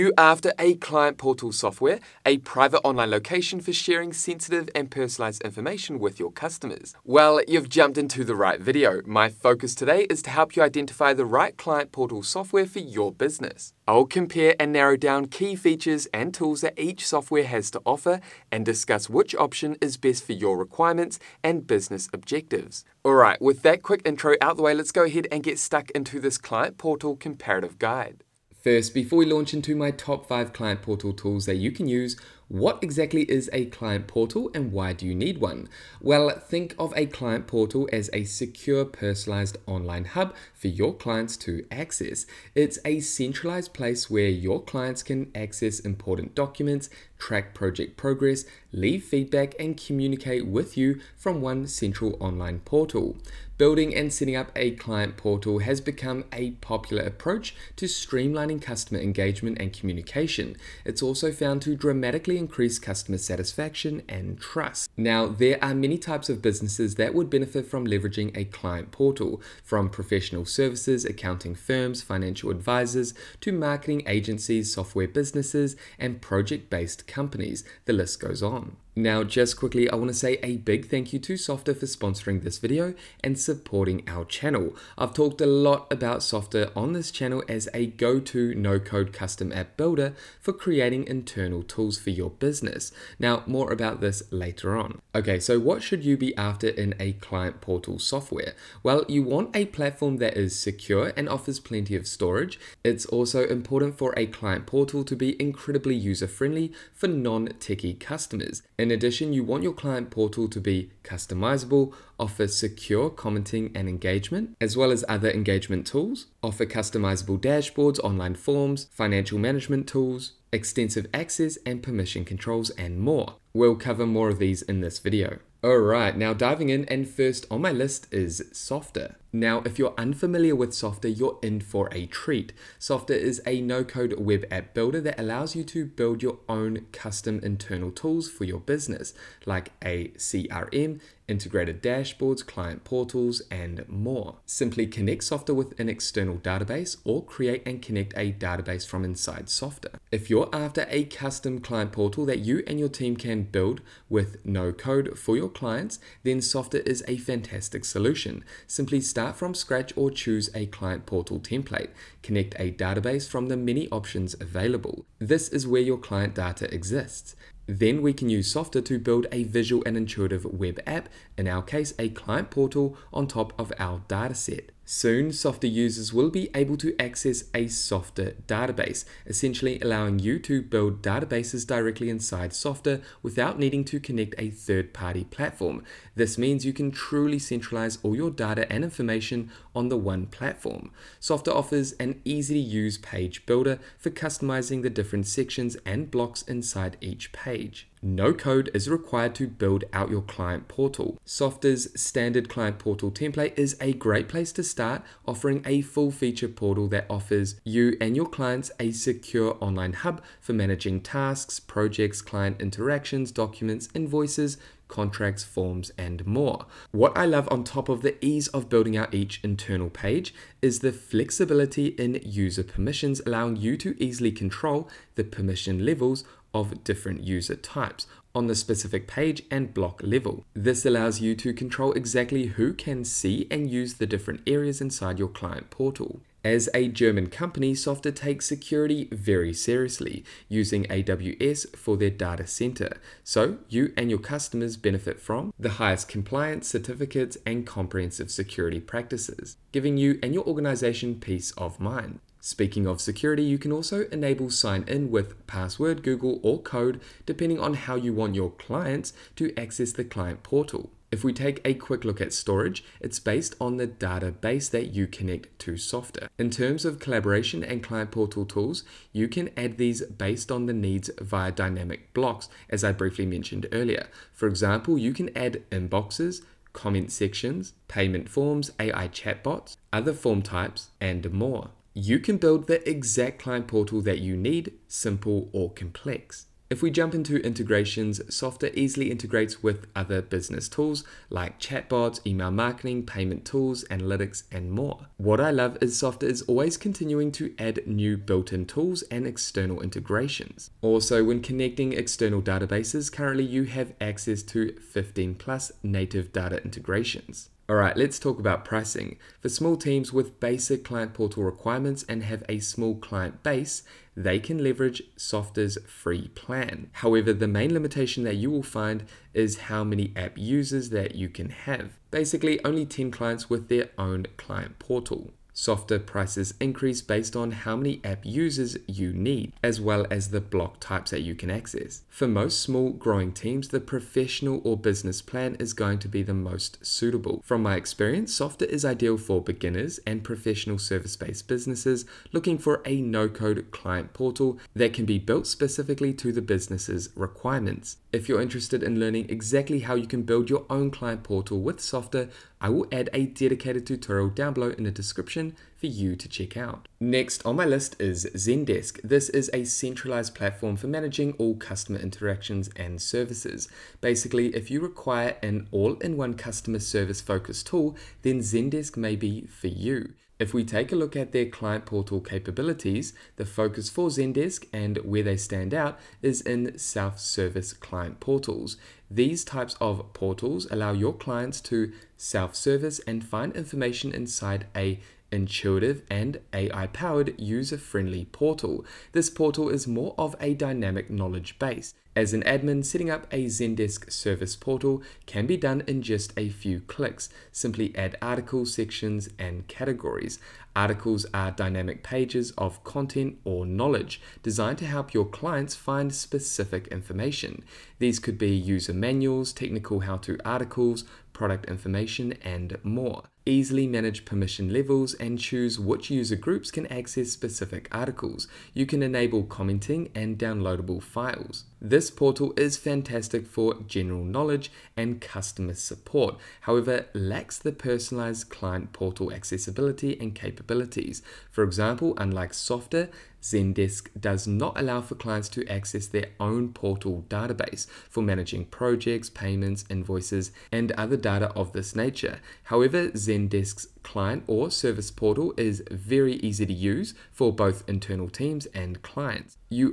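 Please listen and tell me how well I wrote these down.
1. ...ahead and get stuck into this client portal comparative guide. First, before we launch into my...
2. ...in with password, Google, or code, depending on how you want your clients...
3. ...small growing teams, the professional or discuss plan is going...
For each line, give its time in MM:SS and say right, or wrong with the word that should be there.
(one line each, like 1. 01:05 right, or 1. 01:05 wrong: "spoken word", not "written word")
1. 00:25 right
2. 04:14 right
3. 05:32 wrong: "business", not "discuss".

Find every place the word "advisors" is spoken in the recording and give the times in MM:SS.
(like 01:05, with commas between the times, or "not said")
01:12.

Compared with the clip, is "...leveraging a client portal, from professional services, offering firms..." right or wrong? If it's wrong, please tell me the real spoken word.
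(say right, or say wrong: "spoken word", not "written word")
wrong: "accounting", not "offering".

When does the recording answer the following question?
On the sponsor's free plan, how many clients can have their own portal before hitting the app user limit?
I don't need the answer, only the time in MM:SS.
05:22.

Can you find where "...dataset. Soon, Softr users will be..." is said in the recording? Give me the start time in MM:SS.
02:54.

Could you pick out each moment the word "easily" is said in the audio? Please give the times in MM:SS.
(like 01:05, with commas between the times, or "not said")
03:44, 04:48, 06:53.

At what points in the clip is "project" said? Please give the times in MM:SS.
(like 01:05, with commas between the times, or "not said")
00:47, 01:16, 03:31, 07:18.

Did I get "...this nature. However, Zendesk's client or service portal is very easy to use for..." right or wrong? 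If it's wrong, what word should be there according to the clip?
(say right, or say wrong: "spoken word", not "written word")
right.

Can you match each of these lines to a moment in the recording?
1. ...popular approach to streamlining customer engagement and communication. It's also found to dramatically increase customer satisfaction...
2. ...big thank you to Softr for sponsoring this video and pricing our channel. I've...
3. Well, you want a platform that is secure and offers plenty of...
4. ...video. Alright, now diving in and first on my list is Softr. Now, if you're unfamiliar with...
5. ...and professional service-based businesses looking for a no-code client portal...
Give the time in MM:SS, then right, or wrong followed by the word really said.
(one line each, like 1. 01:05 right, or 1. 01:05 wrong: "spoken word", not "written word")
1. 00:56 right
2. 01:20 wrong: "supporting", not "pricing"
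3. 01:38 right
4. 02:04 right
5. 05:40 right.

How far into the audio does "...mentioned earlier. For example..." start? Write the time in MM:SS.
04:33.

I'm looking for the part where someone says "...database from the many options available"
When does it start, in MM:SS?
02:42.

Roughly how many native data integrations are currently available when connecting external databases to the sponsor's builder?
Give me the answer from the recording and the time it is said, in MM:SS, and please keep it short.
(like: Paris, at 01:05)
15+, at 05:04.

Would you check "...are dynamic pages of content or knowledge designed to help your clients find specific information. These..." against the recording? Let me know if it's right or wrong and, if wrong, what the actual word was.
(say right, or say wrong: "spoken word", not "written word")
right.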